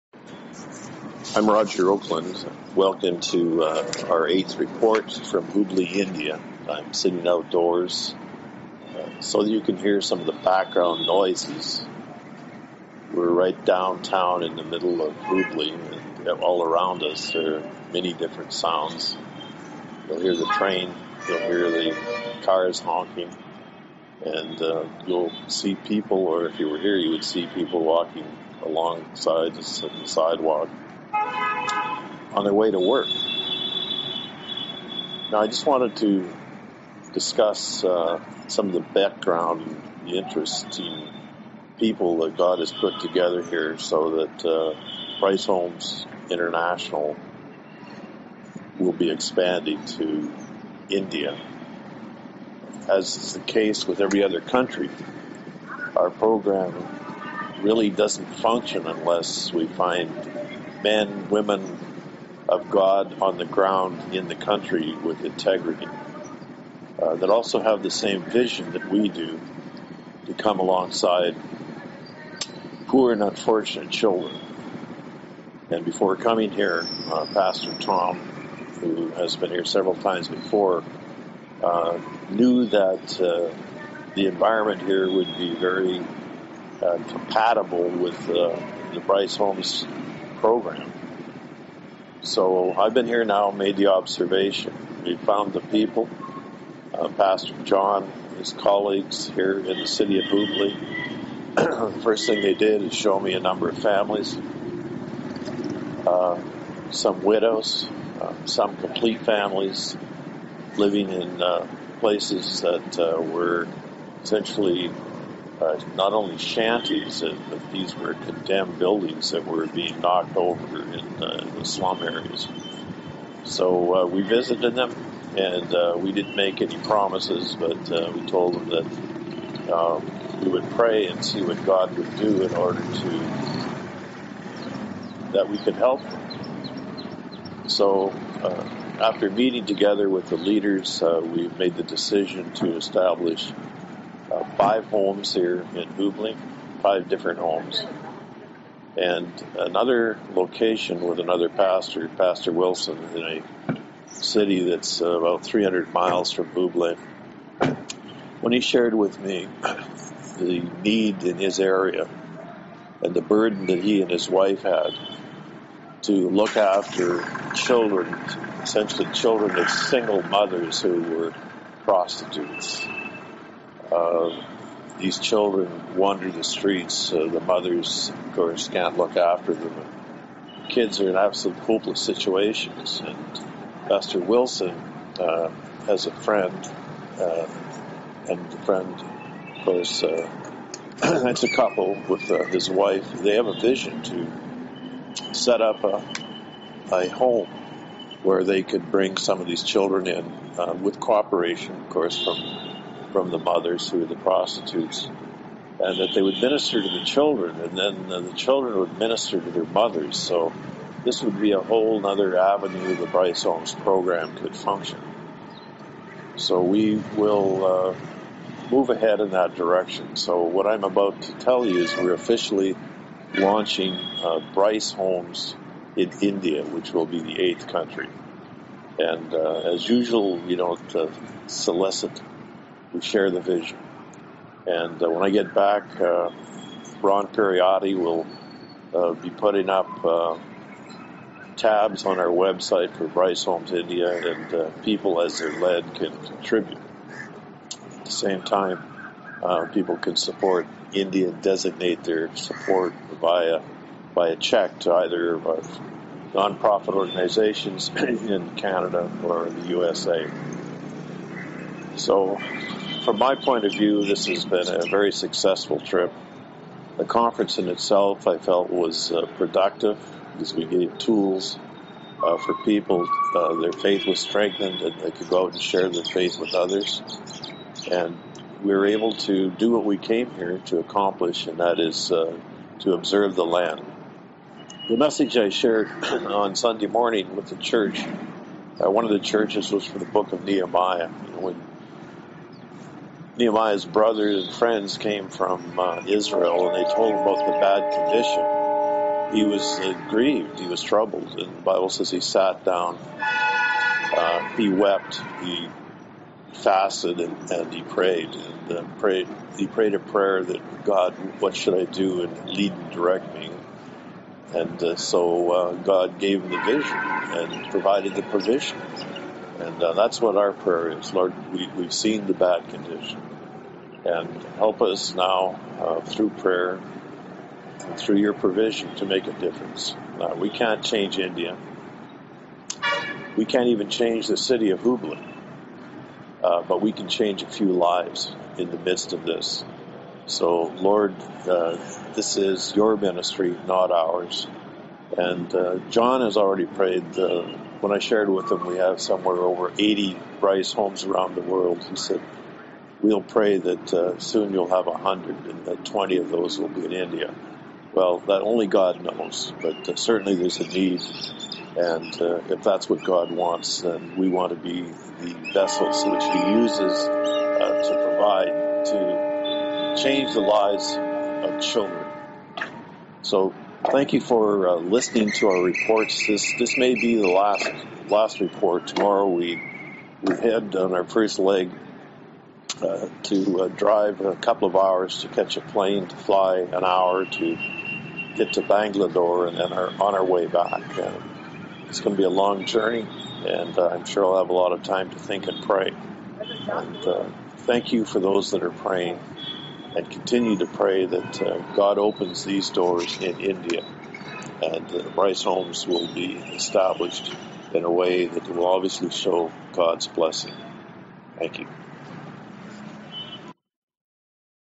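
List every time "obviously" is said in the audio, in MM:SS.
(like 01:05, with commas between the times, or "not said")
06:48.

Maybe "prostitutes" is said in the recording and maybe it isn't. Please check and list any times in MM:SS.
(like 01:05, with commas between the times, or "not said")
02:51, 03:24.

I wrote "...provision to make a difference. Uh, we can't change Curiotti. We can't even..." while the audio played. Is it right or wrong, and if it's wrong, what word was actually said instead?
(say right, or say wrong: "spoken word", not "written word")
wrong: "India", not "Curiotti".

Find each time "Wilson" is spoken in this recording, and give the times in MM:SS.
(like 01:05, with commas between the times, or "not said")
02:32, 03:04.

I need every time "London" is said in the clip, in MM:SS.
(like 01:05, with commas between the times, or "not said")
not said.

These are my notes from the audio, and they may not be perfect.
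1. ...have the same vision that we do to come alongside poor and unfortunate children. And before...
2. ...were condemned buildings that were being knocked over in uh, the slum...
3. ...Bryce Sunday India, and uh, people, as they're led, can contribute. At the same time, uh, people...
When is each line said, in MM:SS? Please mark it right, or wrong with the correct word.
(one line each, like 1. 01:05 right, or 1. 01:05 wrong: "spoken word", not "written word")
1. 01:07 right
2. 01:57 right
3. 04:03 wrong: "Homes", not "Sunday".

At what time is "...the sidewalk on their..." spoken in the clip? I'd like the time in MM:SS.
00:29.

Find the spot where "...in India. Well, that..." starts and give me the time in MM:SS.
05:56.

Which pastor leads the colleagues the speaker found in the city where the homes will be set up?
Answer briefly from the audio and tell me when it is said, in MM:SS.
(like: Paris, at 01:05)
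Pastor John, at 01:37.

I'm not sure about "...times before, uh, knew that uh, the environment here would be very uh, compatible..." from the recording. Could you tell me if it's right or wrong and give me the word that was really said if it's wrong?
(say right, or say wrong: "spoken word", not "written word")
right.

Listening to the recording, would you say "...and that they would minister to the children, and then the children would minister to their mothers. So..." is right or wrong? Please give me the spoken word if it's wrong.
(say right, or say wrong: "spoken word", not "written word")
right.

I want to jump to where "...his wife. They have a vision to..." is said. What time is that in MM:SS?
03:12.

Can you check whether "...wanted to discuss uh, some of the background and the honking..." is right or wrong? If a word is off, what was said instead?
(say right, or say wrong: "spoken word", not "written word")
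wrong: "interesting", not "honking".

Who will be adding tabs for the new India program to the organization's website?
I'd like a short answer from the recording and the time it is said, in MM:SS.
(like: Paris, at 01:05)
Ron Curiotti, at 03:57.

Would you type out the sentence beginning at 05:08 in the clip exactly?
And uh, prayed, he prayed a prayer that God, what should I do, and lead and direct me.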